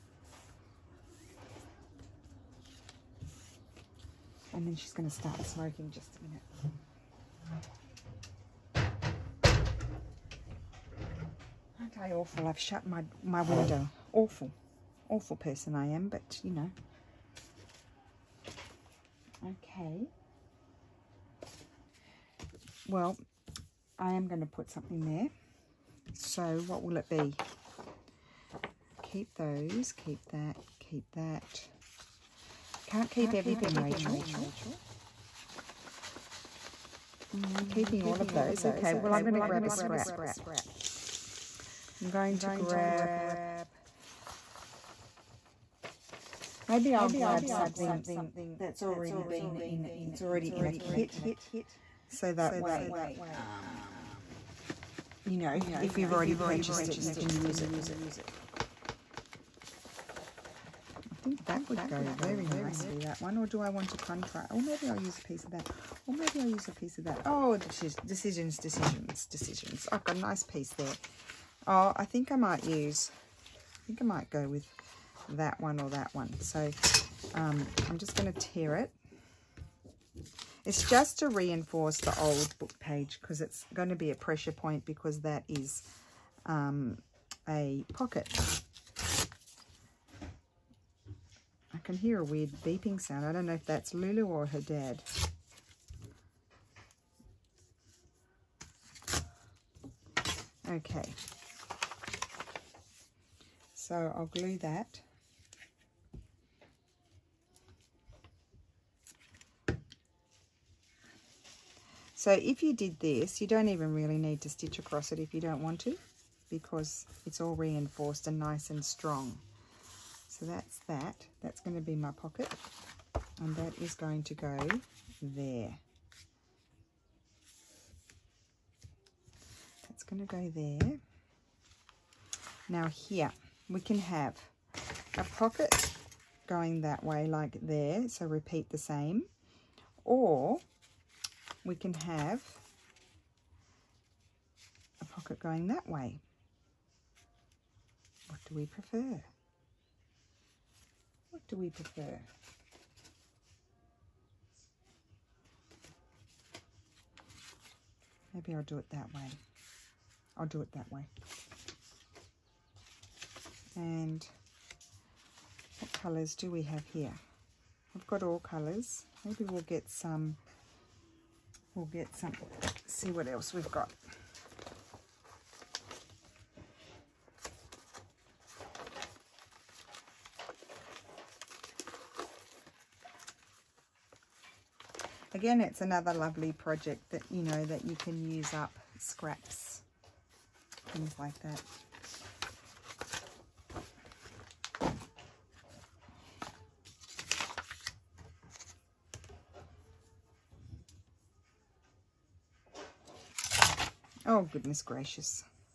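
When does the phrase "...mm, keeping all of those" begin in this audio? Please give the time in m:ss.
0:37.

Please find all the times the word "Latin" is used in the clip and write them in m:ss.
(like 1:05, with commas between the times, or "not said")
not said.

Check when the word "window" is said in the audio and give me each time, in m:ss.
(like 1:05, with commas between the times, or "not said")
0:13.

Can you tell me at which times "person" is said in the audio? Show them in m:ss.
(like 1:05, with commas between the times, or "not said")
0:15.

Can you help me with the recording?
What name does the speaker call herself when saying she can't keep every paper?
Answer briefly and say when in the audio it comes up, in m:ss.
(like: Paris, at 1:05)
Rachel, at 0:33.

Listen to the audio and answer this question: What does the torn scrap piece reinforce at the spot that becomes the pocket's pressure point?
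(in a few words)
The old book page.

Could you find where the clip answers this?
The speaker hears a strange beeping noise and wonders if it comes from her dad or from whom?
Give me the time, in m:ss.
1:33.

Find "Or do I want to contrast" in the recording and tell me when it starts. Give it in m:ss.
1:03.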